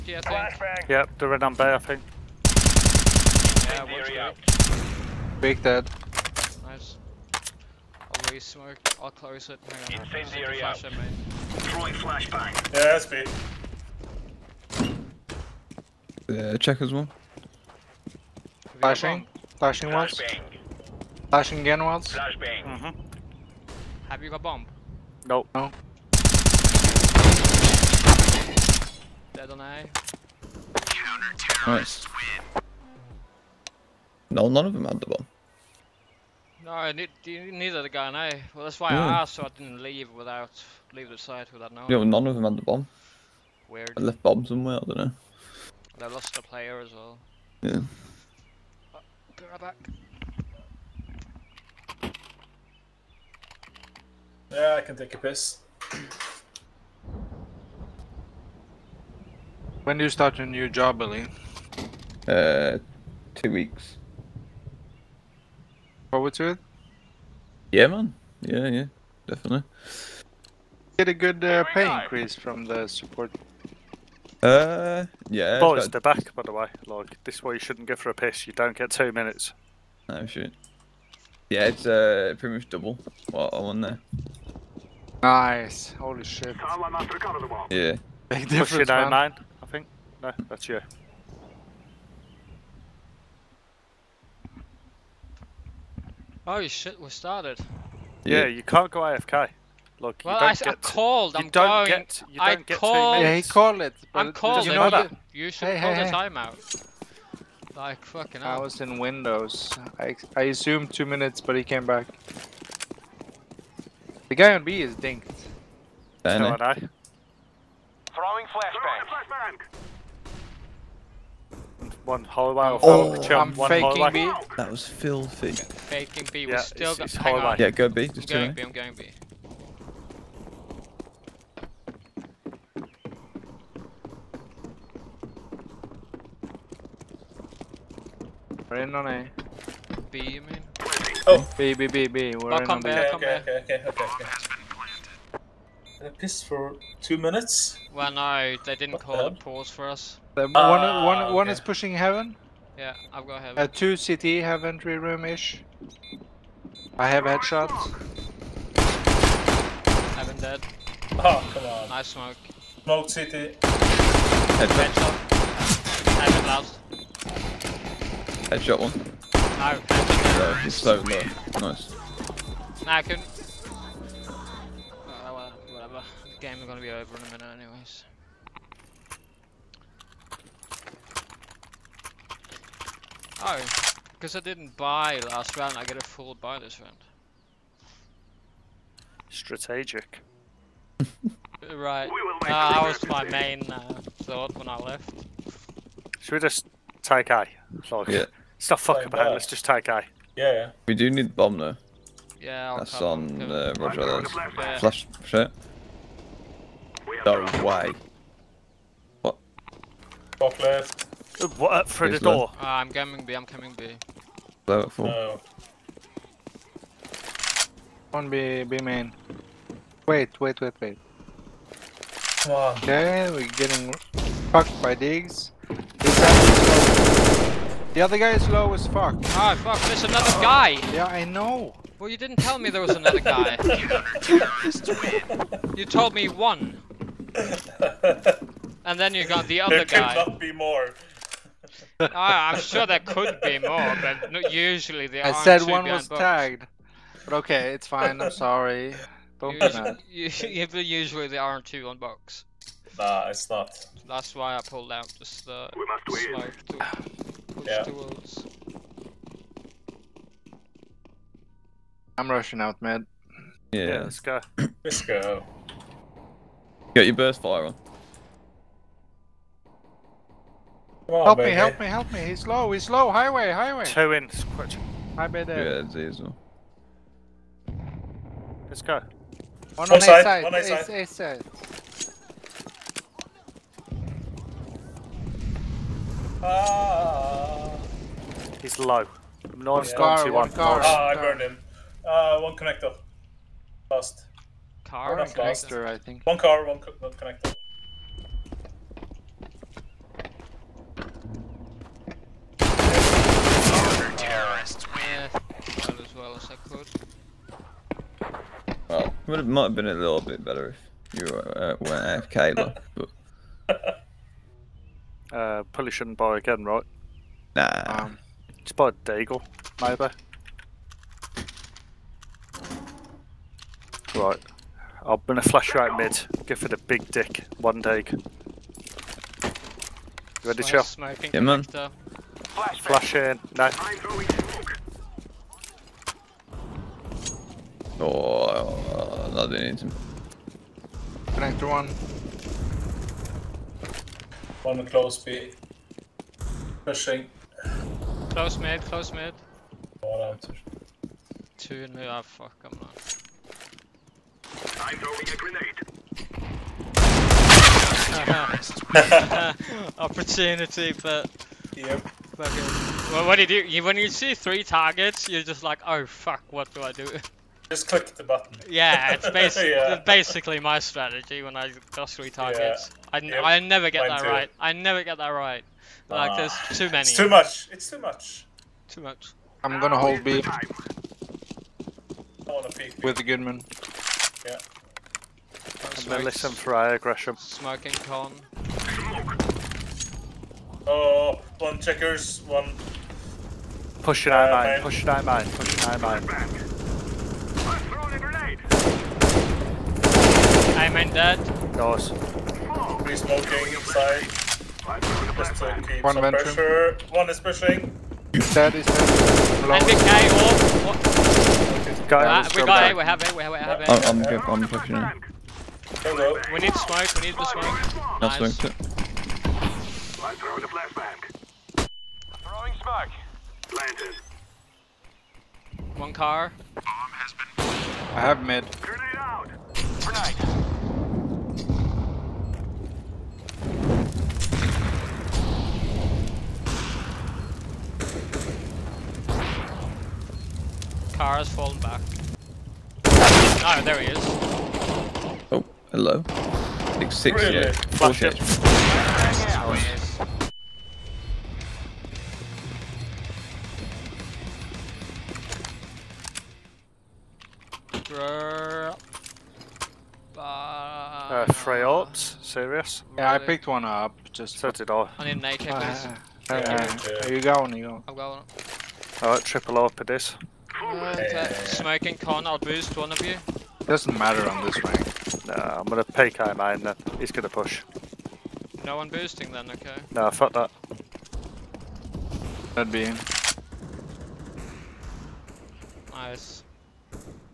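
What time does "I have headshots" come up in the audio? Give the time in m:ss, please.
2:36.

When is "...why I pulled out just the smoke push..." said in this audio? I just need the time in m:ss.
4:14.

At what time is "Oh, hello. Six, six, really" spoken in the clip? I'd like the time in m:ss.
7:25.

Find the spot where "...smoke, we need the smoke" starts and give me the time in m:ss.
6:56.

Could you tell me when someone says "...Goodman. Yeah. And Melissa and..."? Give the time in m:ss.
6:23.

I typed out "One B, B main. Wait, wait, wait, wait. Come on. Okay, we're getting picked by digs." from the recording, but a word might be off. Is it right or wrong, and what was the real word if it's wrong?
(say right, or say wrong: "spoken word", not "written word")
wrong: "fucked", not "picked".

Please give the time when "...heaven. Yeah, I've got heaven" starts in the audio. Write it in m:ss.
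2:31.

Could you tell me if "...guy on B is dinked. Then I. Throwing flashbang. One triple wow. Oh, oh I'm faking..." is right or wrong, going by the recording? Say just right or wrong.
wrong.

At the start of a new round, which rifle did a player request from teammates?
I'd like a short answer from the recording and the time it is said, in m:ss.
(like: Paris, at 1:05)
AK, at 7:45.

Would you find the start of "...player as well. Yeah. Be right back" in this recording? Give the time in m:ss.
0:46.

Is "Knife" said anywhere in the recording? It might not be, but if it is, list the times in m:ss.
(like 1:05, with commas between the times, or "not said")
4:49.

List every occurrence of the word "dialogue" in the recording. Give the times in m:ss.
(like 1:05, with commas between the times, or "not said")
not said.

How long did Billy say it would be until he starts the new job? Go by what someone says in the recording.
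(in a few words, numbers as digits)
2 weeks.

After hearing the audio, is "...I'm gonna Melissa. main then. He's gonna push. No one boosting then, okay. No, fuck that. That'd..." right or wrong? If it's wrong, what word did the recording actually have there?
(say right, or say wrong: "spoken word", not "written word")
wrong: "Kai", not "Melissa".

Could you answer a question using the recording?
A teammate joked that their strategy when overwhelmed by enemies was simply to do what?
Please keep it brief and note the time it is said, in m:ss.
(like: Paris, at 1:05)
Click the button, at 6:07.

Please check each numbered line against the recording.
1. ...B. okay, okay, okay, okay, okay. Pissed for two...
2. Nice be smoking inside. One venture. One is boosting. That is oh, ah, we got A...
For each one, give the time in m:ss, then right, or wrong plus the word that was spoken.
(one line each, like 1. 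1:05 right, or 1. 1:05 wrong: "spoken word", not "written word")
1. 2:22 right
2. 6:41 wrong: "pushing", not "boosting".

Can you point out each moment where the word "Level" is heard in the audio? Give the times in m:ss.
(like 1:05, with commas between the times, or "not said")
3:34.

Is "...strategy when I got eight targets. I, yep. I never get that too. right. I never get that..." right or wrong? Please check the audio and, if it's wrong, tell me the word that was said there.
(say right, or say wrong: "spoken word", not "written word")
wrong: "three", not "eight".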